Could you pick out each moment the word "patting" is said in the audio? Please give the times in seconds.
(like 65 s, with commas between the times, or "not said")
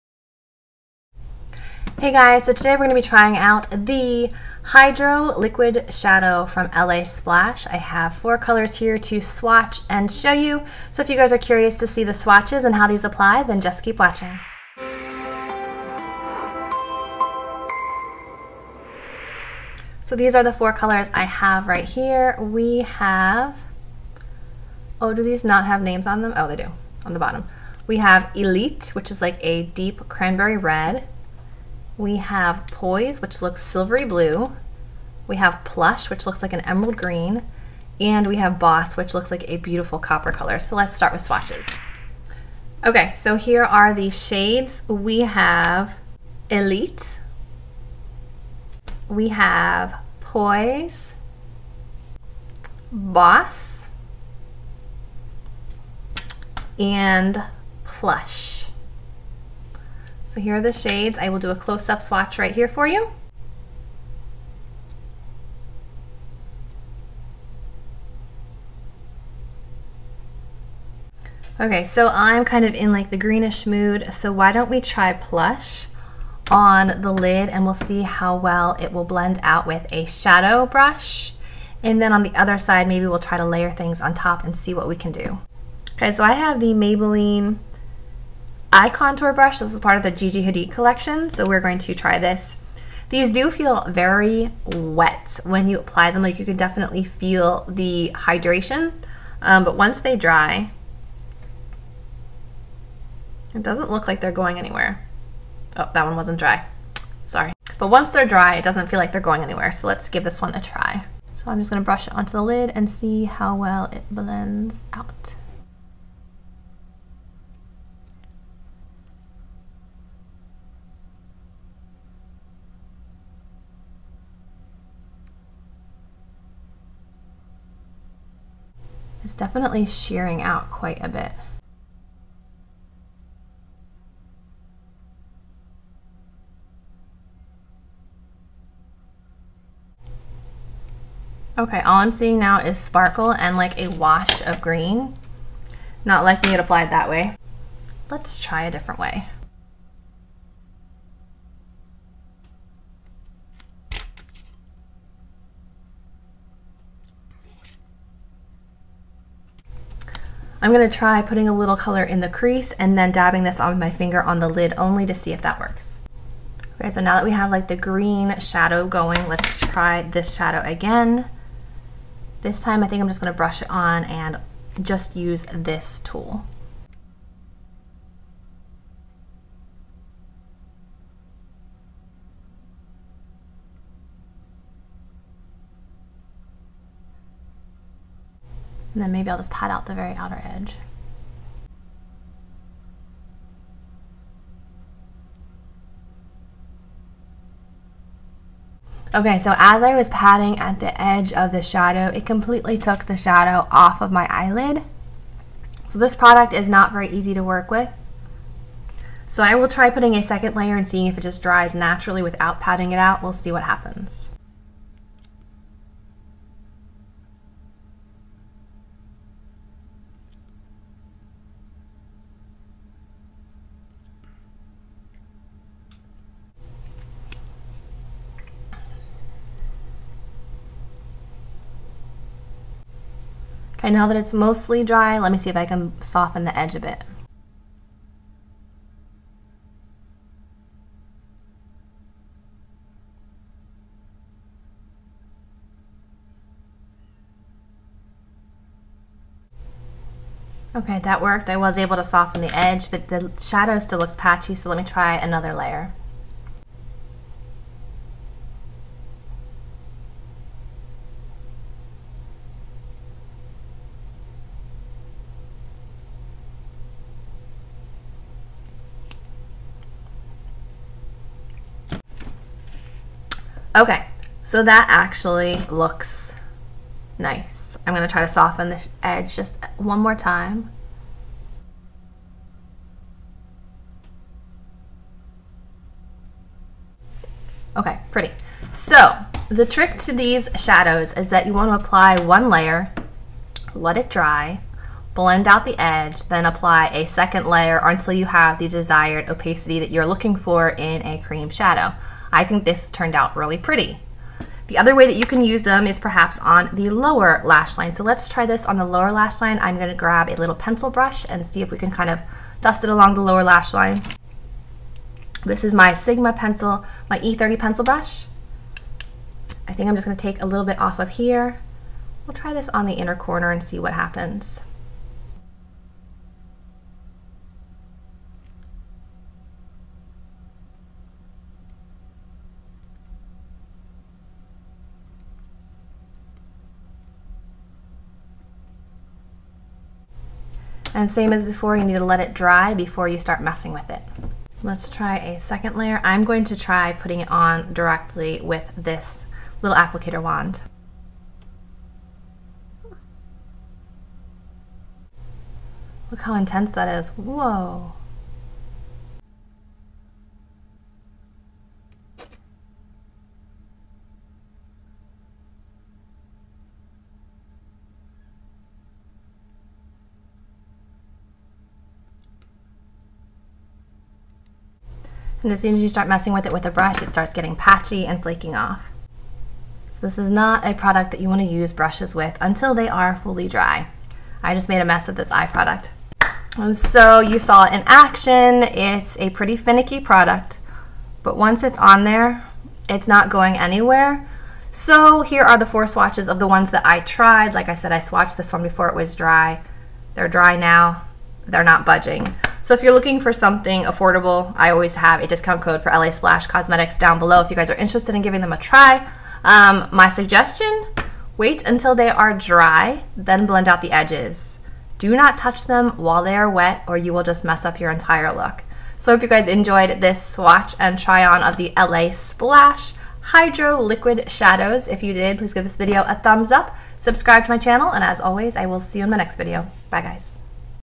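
200 s, 212 s.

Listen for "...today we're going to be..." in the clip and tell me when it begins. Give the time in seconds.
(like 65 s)
2 s.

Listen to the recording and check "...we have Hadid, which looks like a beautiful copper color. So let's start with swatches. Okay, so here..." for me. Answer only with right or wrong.
wrong.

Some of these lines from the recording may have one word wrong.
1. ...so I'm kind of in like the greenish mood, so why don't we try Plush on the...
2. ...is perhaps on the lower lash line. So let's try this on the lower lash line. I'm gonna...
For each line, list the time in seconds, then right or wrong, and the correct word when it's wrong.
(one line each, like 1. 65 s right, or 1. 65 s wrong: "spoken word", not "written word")
1. 71 s right
2. 305 s right.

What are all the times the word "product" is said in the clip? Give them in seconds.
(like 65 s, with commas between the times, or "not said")
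206 s, 380 s, 385 s, 389 s.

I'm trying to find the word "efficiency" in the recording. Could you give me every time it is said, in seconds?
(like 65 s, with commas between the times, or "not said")
not said.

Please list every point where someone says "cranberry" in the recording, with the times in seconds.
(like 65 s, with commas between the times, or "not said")
30 s.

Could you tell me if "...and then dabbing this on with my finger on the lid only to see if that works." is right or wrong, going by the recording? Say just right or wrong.
right.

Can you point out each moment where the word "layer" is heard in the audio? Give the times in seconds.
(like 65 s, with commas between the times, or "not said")
83 s, 210 s, 255 s, 292 s, 297 s, 345 s.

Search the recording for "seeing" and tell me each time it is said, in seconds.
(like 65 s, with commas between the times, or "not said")
142 s, 210 s.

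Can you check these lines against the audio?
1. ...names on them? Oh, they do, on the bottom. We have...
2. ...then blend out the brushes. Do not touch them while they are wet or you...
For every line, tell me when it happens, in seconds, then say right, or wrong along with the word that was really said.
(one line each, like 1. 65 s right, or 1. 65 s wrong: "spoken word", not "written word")
1. 25 s right
2. 413 s wrong: "edges", not "brushes".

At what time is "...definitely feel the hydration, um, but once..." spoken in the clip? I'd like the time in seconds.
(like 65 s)
96 s.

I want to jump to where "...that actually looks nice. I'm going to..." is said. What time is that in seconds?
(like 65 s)
274 s.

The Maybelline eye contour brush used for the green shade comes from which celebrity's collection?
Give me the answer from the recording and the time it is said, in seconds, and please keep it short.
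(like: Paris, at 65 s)
Gigi Hadid, at 90 s.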